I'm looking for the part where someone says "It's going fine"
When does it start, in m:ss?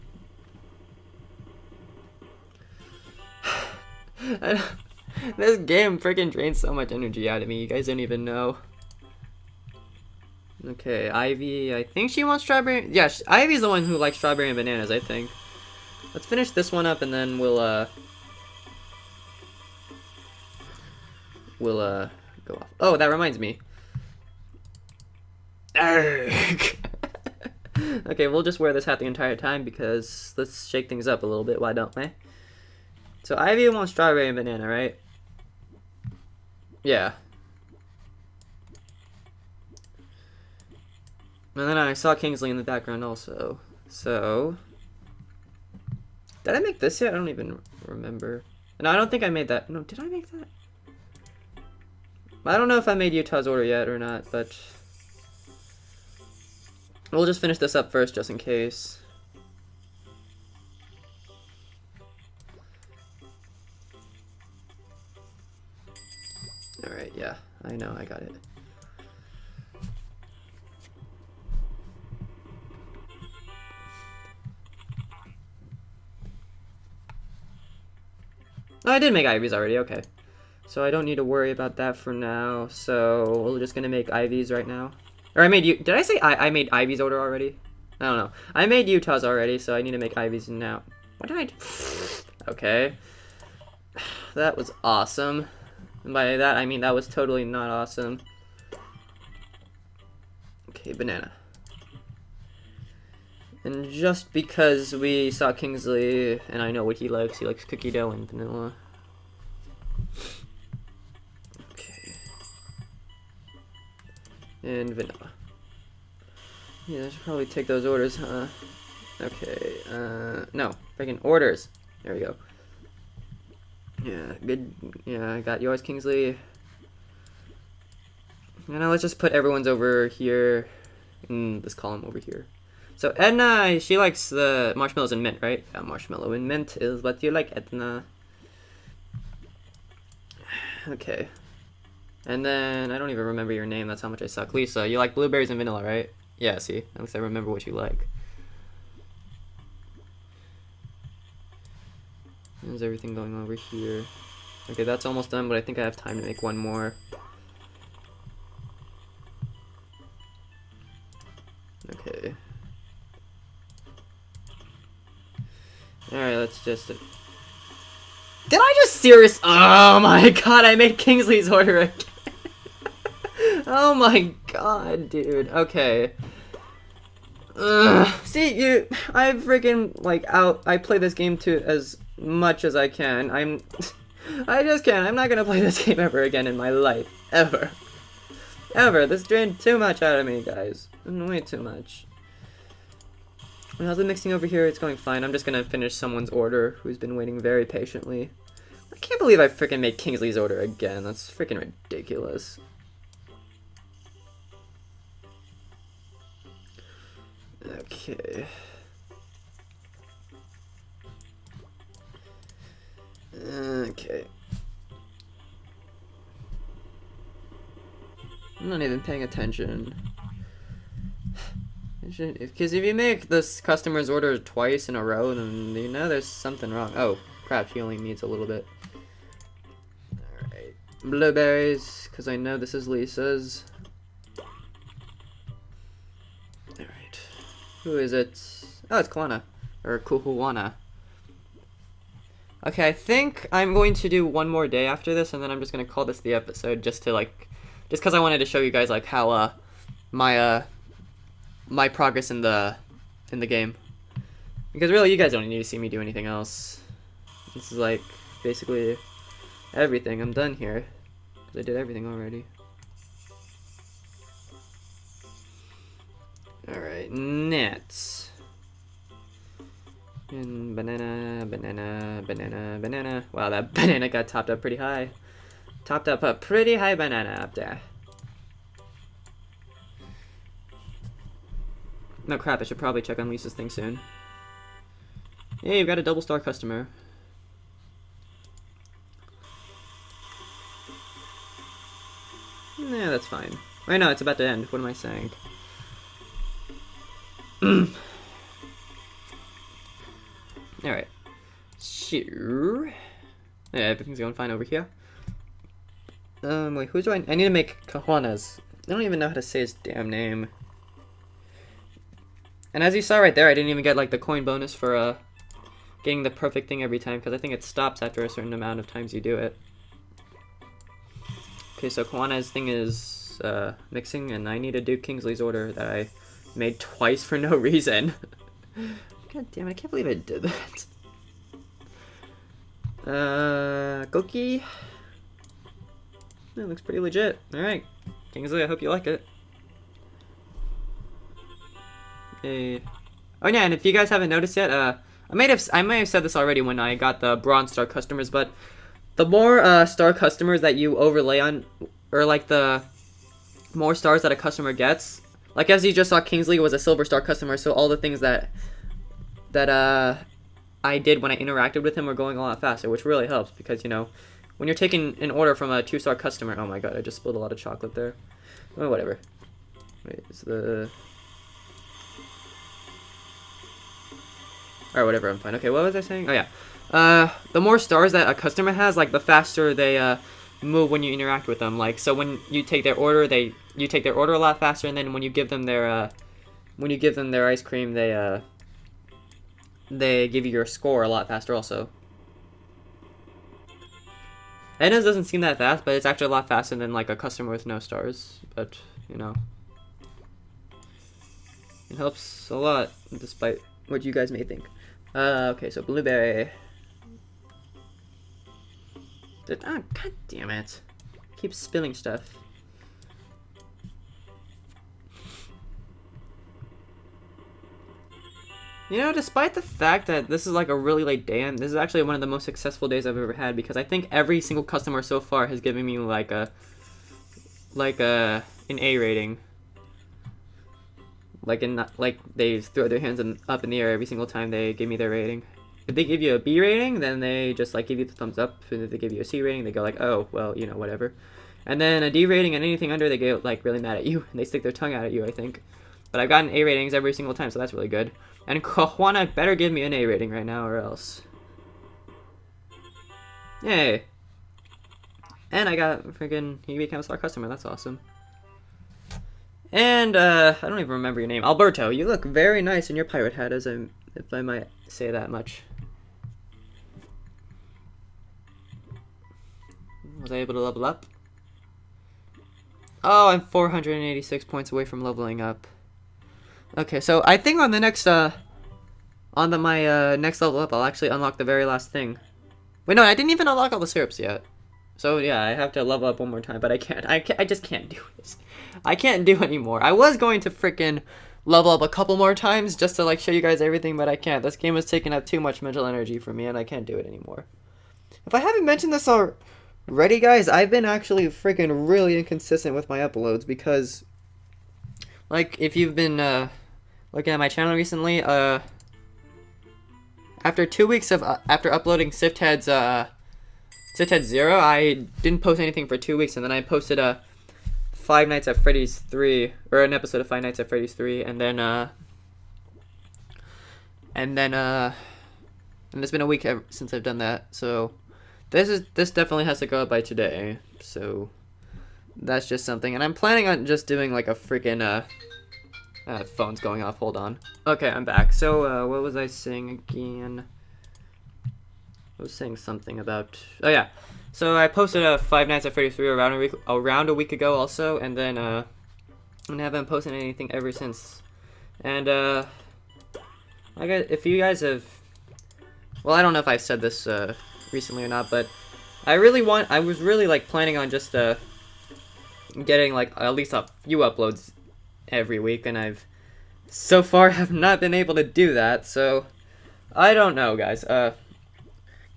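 3:14.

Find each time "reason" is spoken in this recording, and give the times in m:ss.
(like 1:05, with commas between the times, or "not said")
5:27.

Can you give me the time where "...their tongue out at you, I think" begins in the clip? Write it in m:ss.
7:24.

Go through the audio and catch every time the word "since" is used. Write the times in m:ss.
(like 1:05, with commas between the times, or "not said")
8:46, 9:10.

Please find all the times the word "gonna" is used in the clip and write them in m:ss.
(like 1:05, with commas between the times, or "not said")
3:05, 3:15.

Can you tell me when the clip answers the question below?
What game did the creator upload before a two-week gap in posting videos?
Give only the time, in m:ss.
8:33.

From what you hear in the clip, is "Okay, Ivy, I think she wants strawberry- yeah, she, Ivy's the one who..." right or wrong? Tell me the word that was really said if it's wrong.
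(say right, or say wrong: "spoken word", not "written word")
right.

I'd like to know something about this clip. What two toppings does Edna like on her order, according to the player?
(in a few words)
marshmallow and mint.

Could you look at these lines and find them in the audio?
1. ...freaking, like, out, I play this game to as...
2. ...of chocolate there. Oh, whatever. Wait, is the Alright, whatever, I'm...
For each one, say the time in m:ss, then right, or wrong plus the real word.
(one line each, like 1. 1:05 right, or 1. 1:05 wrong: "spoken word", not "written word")
1. 2:59 right
2. 6:07 right.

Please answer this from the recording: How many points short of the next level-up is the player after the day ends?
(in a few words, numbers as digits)
486.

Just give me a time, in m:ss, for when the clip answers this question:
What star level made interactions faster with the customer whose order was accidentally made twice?
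5:56.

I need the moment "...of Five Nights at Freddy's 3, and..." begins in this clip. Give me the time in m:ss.
8:40.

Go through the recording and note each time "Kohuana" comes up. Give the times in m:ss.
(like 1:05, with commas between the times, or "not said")
7:28.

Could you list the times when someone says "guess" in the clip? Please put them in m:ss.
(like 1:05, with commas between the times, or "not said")
9:13.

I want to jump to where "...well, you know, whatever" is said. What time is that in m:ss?
7:20.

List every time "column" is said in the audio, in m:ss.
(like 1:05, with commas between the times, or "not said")
2:11.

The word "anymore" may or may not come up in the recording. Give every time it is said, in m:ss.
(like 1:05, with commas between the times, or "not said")
8:09, 8:17.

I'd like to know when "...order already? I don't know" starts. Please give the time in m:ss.
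1:26.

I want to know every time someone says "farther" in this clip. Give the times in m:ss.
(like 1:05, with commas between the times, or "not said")
not said.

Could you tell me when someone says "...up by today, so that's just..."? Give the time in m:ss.
8:49.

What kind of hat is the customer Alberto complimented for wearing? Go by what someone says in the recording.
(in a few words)
pirate hat.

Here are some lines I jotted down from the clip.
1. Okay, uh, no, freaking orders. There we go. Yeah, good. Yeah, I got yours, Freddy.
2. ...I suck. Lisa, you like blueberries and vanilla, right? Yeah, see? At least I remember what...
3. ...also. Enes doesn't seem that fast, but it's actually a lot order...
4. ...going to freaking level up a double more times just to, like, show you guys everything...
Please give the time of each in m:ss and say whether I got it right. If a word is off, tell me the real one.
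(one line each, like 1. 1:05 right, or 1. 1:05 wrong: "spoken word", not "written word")
1. 1:59 wrong: "Kingsley", not "Freddy"
2. 2:24 right
3. 6:31 wrong: "faster", not "order"
4. 8:10 wrong: "couple", not "double".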